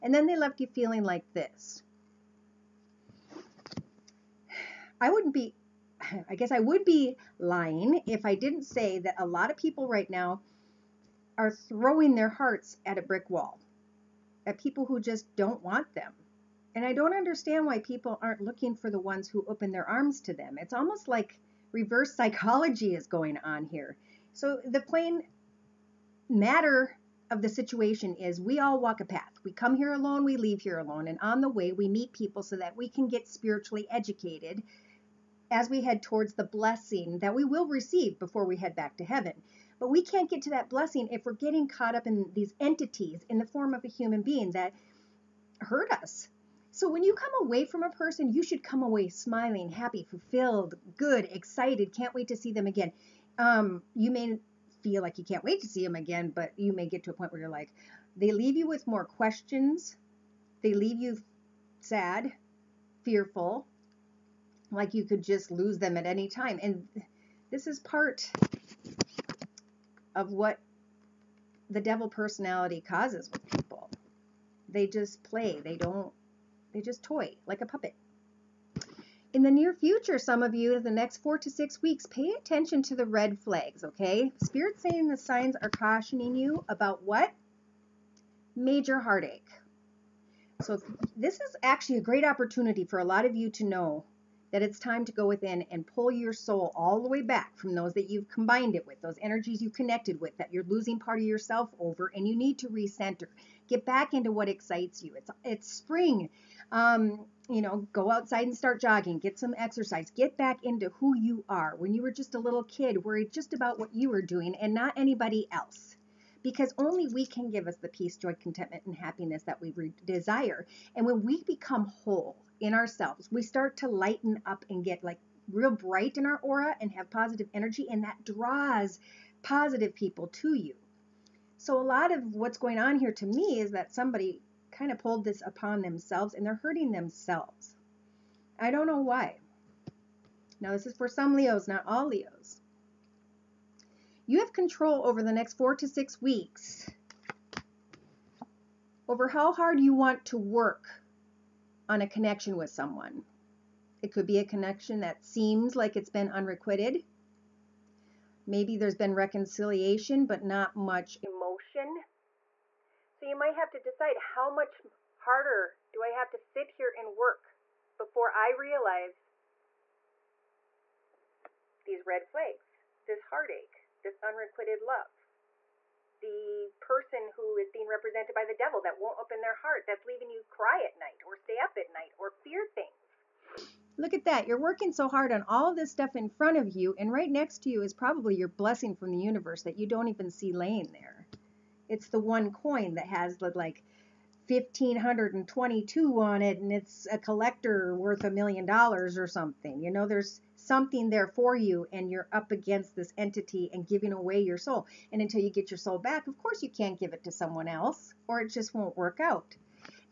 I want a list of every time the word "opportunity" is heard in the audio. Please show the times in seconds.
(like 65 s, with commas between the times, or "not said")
92 s.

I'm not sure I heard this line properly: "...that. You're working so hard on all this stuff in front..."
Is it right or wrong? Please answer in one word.
right.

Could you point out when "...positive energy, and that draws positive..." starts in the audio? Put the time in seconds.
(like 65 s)
127 s.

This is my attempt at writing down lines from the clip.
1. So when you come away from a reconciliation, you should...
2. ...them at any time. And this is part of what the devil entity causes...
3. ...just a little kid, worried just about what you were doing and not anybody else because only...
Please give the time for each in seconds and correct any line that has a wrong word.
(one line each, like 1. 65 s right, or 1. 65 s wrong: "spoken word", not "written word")
1. 46 s wrong: "person", not "reconciliation"
2. 65 s wrong: "personality", not "entity"
3. 112 s right.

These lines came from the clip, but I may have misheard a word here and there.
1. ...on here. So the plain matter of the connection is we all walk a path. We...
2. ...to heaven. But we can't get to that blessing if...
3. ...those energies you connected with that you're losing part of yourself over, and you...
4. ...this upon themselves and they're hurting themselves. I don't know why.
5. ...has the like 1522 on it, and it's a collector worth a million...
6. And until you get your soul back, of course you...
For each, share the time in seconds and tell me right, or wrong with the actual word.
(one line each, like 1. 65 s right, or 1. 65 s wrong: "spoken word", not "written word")
1. 23 s wrong: "situation", not "connection"
2. 38 s right
3. 99 s right
4. 135 s right
5. 193 s right
6. 205 s right.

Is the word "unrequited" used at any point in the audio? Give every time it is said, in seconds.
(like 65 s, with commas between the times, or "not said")
156 s, 174 s.